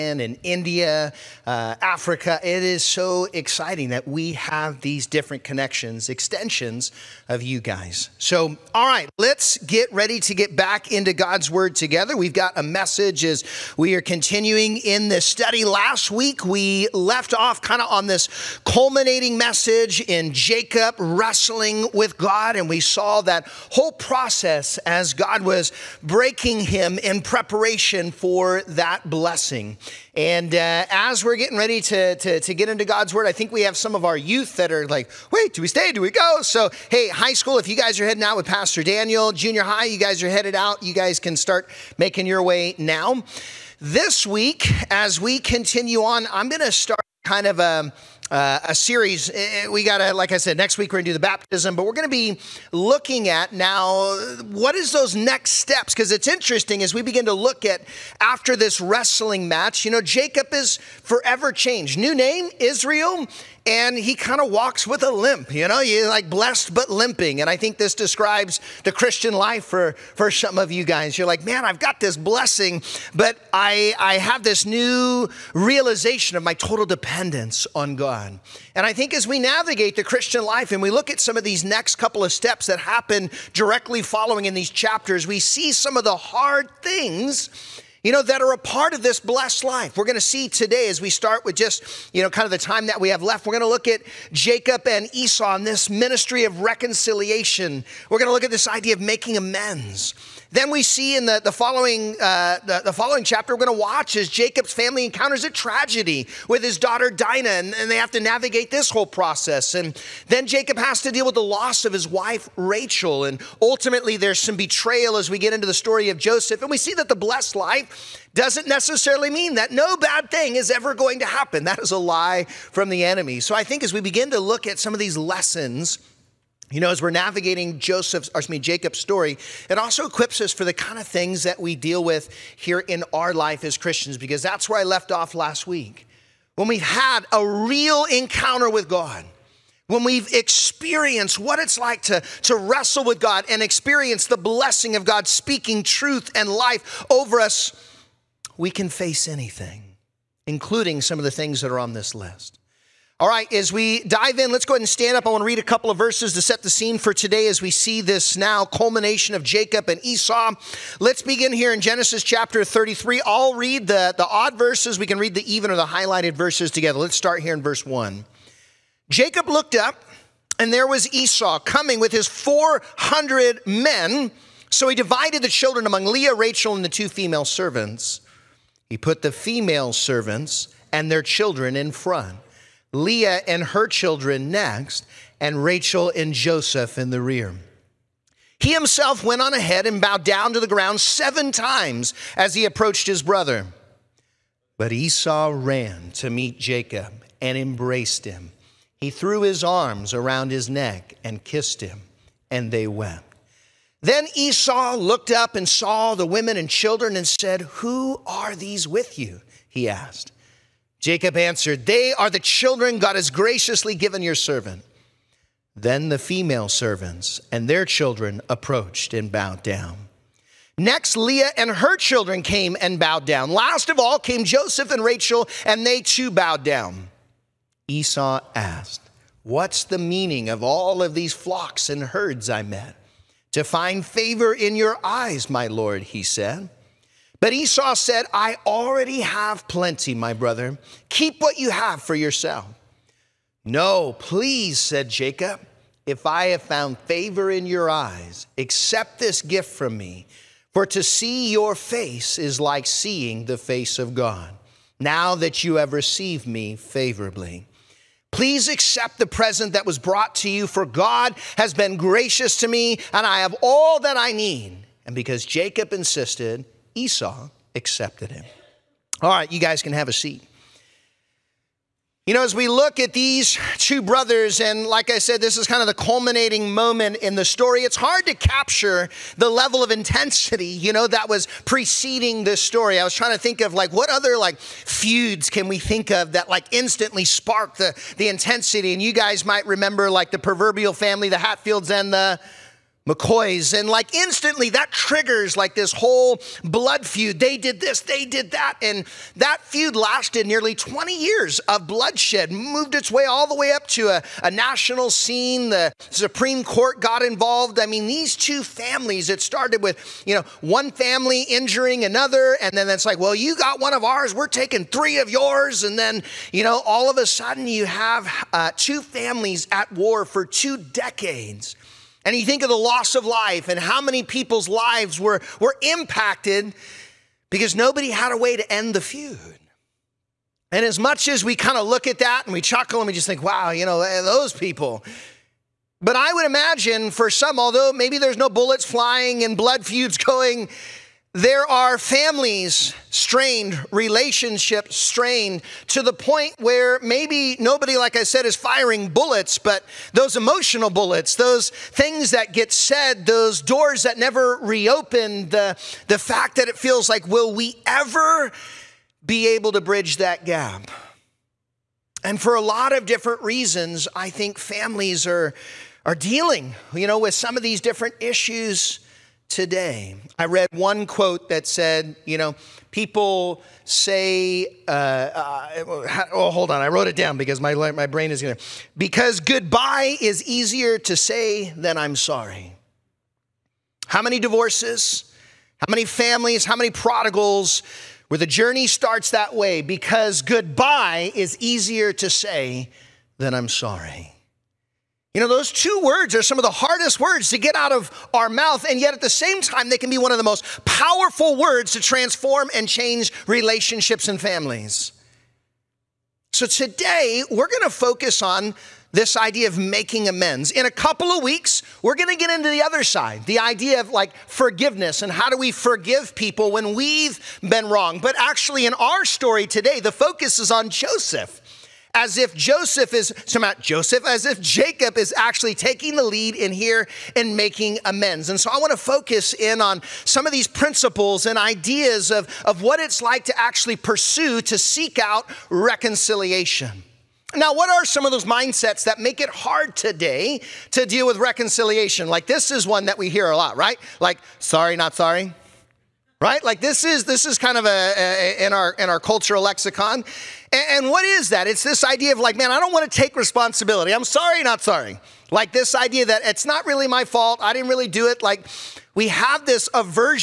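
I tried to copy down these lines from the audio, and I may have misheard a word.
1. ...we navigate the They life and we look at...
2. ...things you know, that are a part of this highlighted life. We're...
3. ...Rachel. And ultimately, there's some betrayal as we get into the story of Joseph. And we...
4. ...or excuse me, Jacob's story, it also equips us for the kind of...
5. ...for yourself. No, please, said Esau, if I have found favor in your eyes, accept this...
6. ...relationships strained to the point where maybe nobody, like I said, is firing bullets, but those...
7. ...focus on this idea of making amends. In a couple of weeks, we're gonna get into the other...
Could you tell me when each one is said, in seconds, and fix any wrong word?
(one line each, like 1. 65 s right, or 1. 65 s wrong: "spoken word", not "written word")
1. 79 s wrong: "Christian", not "They"
2. 86 s wrong: "blessed", not "highlighted"
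3. 112 s right
4. 128 s right
5. 242 s wrong: "Jacob", not "Esau"
6. 343 s right
7. 407 s right.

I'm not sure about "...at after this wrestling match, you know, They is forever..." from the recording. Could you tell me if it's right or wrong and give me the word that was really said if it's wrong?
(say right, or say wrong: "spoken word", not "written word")
wrong: "Jacob", not "They".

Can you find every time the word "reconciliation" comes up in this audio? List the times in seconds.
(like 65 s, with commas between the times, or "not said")
96 s, 435 s, 441 s.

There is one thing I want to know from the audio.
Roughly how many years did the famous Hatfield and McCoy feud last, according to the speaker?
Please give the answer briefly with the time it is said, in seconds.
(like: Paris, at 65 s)
20, at 300 s.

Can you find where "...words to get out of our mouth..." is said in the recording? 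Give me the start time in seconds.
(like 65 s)
397 s.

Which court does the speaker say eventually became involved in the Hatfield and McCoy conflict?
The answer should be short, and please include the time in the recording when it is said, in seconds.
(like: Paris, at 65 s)
The Supreme Court, at 305 s.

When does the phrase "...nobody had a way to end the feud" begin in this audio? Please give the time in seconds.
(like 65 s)
327 s.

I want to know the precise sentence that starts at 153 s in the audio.
All right, as we dive in, let's go ahead and stand up.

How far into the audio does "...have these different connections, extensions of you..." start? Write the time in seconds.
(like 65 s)
4 s.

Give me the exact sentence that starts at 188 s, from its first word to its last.
He himself went on ahead and bowed down to the ground seven times as he approached his brother.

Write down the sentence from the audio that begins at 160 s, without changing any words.
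Let's begin here in Genesis chapter 33.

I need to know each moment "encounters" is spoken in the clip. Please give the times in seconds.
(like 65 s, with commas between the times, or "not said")
105 s, 138 s.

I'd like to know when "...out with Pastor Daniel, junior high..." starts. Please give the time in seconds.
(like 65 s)
38 s.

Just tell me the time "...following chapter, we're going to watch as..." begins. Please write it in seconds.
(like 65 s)
102 s.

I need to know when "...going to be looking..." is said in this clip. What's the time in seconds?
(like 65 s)
51 s.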